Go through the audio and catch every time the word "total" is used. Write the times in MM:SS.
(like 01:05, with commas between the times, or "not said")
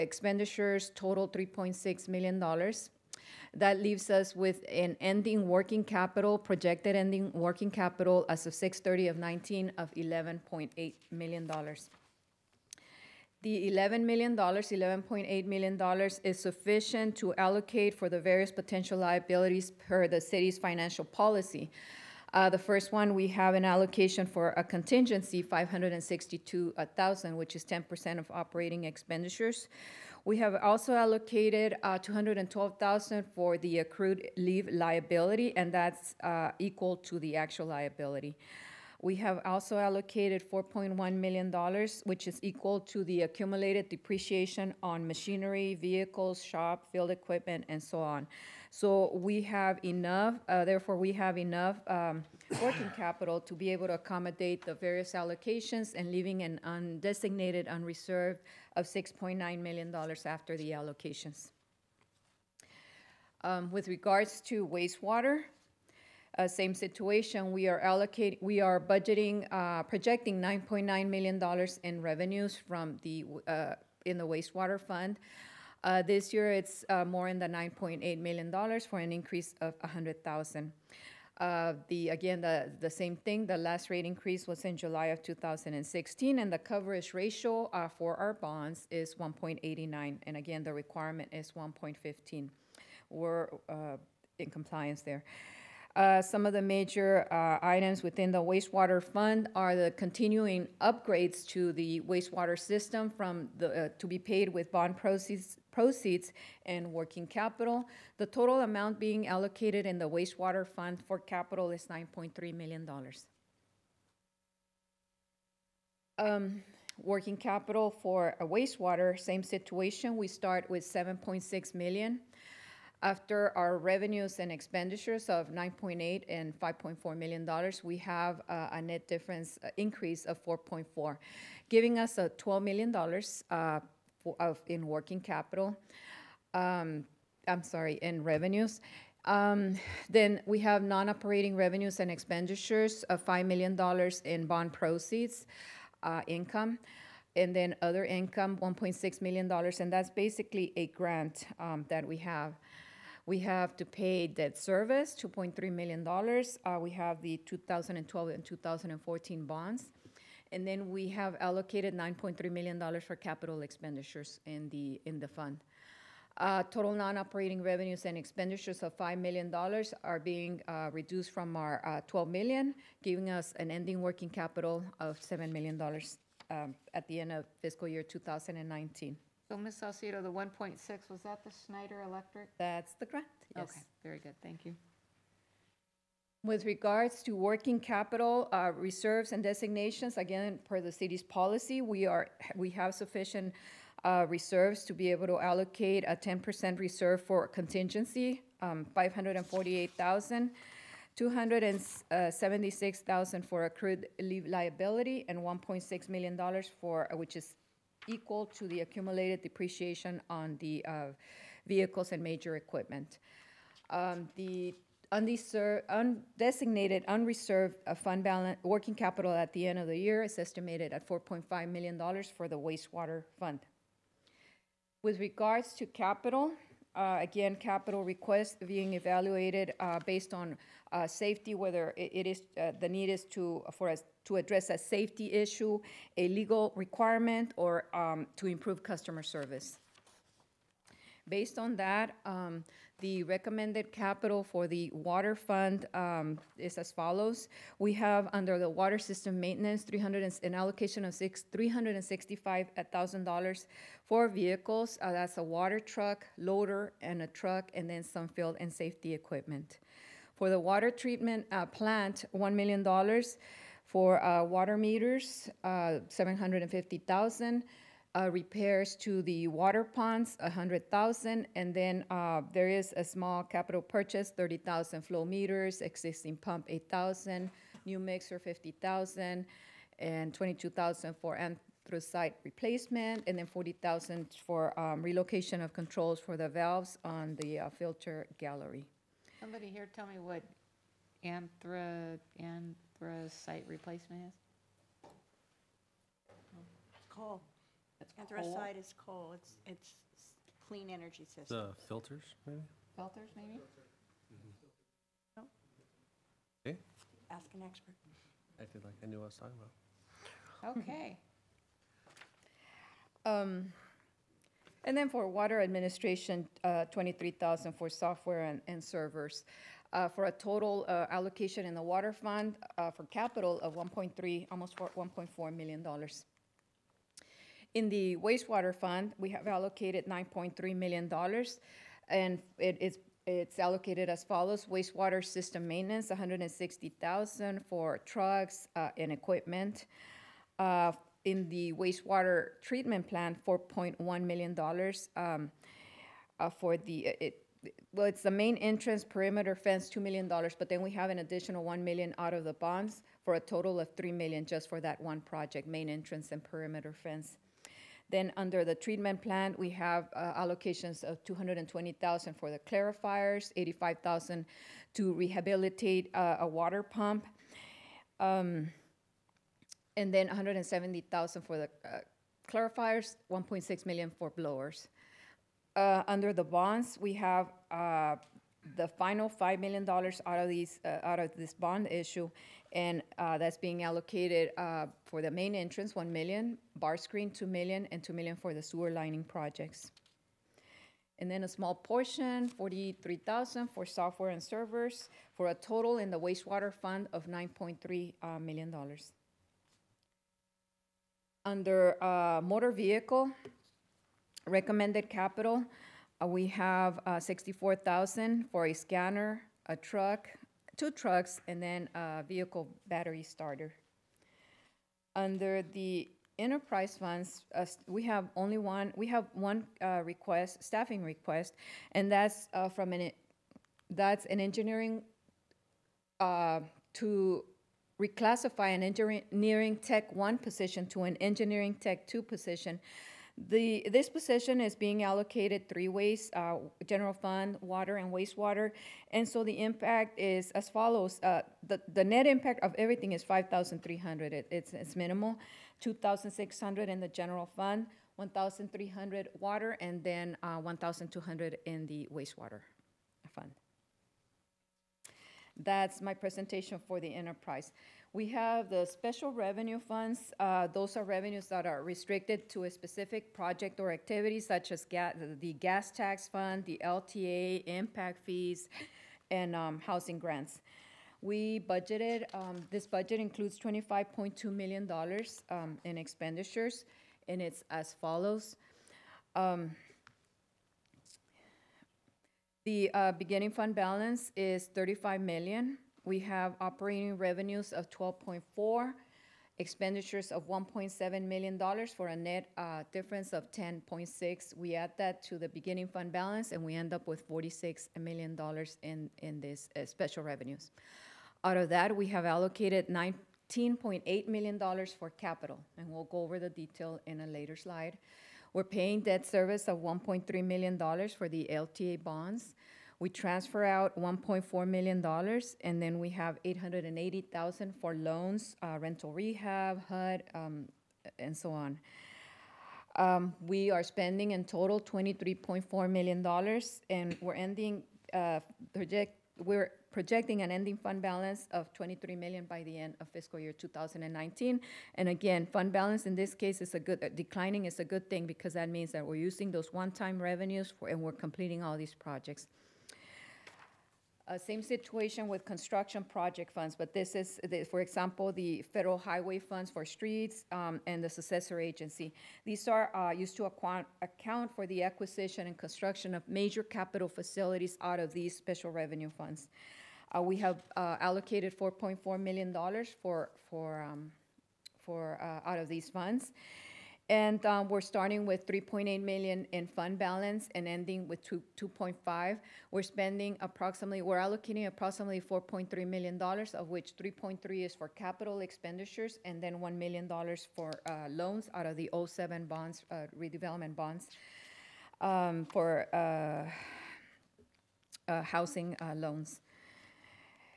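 00:00, 01:48, 02:46, 05:20, 05:53, 06:35, 08:44.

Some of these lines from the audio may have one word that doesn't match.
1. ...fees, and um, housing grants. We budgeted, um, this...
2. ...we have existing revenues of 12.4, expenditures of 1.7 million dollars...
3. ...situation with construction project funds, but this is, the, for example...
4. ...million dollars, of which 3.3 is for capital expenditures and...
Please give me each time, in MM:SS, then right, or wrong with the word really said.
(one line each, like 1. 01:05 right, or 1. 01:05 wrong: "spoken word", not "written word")
1. 07:48 right
2. 08:06 wrong: "operating", not "existing"
3. 09:04 right
4. 09:35 right.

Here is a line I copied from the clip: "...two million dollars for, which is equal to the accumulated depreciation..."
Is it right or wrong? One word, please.
wrong.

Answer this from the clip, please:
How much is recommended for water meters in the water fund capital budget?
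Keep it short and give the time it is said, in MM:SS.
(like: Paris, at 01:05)
$750,000, at 04:26.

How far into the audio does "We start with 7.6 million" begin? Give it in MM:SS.
02:00.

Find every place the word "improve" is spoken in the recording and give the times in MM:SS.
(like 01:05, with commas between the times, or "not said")
03:58.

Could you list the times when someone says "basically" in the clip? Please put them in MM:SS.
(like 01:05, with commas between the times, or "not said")
02:30.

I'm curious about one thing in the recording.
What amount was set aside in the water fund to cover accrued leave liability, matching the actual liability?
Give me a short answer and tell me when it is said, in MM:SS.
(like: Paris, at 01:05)
$212,000, at 00:31.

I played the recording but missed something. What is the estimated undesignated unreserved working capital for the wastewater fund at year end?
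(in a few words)
$4.5 million.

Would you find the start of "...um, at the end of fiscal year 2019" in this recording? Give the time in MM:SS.
02:56.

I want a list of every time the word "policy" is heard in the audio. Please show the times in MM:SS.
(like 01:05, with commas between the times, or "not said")
00:21, 03:11.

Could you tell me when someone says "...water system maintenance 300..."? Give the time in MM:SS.
04:08.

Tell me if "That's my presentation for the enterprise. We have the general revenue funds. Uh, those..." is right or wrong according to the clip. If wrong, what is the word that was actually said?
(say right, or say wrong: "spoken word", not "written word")
wrong: "special", not "general".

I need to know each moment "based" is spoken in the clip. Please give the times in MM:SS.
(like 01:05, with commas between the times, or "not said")
03:50, 04:01.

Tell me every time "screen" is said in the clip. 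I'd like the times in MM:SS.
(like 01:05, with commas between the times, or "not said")
06:26.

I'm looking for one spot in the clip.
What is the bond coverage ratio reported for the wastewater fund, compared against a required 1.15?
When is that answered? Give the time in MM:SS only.
01:29.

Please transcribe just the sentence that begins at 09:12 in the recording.
These are uh, used to account for the acquisition and construction of major capital facilities out of these special revenue funds.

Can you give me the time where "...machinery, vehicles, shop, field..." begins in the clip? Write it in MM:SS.
00:45.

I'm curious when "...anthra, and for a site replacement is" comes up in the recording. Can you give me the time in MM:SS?
04:51.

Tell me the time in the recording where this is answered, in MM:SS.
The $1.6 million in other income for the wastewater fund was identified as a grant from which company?
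03:01.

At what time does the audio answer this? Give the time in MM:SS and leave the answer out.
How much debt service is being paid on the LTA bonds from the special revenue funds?
08:29.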